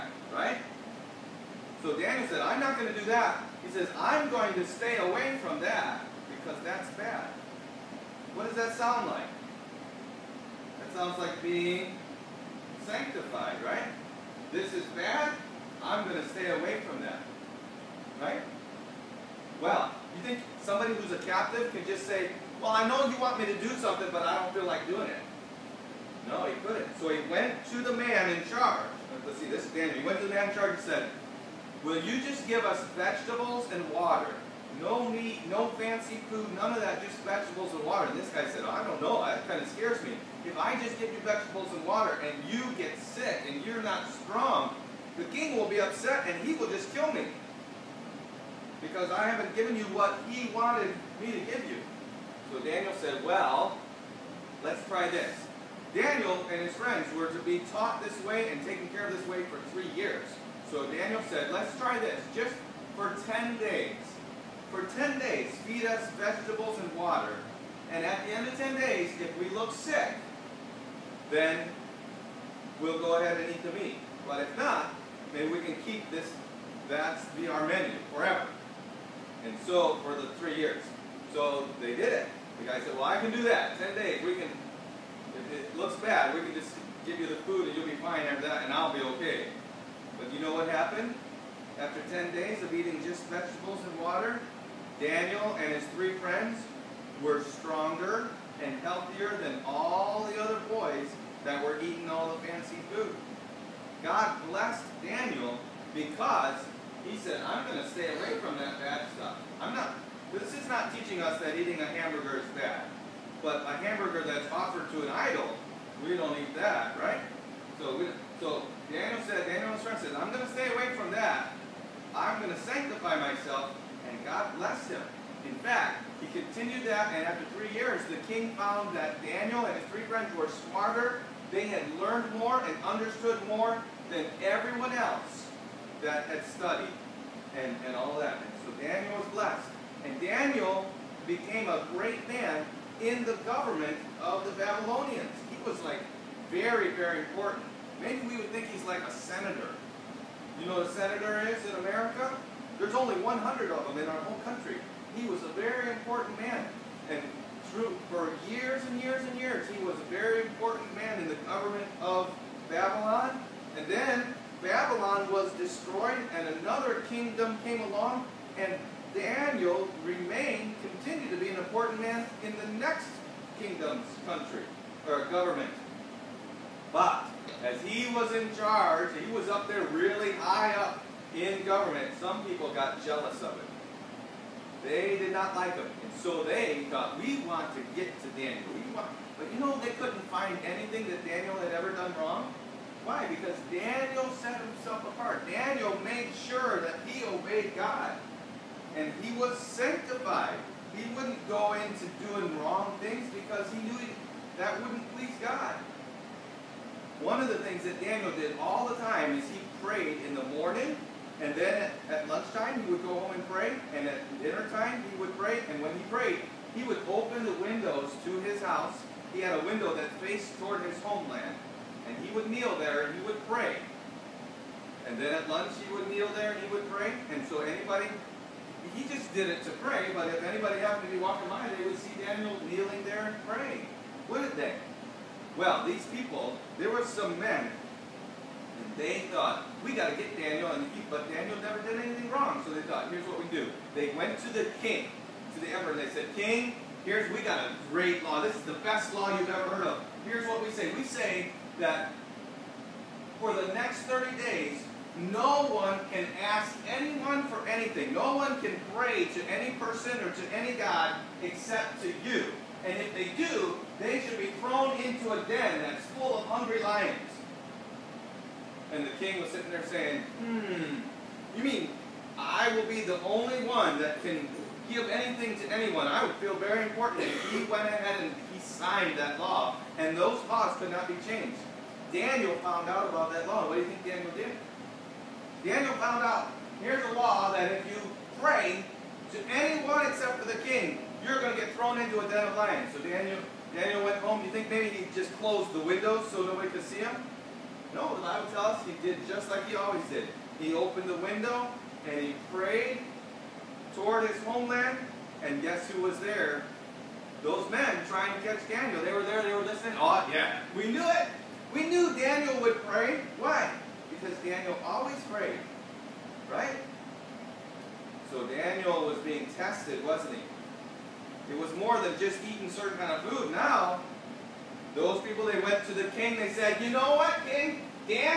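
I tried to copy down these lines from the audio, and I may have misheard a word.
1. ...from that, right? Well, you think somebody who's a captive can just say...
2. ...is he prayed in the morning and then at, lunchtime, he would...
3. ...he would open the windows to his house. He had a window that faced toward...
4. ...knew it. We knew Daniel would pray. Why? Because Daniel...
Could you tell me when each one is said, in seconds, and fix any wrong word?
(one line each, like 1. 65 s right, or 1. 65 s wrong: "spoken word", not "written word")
1. 16 s right
2. 209 s right
3. 216 s right
4. 310 s right.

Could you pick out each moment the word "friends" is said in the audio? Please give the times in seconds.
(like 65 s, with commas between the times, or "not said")
56 s, 96 s, 119 s, 130 s.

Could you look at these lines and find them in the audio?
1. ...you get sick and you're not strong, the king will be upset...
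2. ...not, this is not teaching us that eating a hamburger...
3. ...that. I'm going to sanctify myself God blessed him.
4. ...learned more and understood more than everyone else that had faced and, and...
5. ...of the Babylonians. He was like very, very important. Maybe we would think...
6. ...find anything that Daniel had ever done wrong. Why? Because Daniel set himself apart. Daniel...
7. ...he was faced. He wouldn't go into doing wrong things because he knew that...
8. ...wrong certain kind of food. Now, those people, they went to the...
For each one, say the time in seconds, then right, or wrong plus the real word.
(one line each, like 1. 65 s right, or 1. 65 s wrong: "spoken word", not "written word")
1. 42 s right
2. 109 s right
3. 121 s right
4. 132 s wrong: "studied", not "faced"
5. 144 s right
6. 190 s right
7. 199 s wrong: "sanctified", not "faced"
8. 322 s wrong: "eating", not "wrong".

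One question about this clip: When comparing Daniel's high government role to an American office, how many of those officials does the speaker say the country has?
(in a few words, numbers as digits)
100.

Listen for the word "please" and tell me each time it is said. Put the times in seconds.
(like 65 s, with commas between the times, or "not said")
205 s.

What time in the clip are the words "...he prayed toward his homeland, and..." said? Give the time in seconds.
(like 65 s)
302 s.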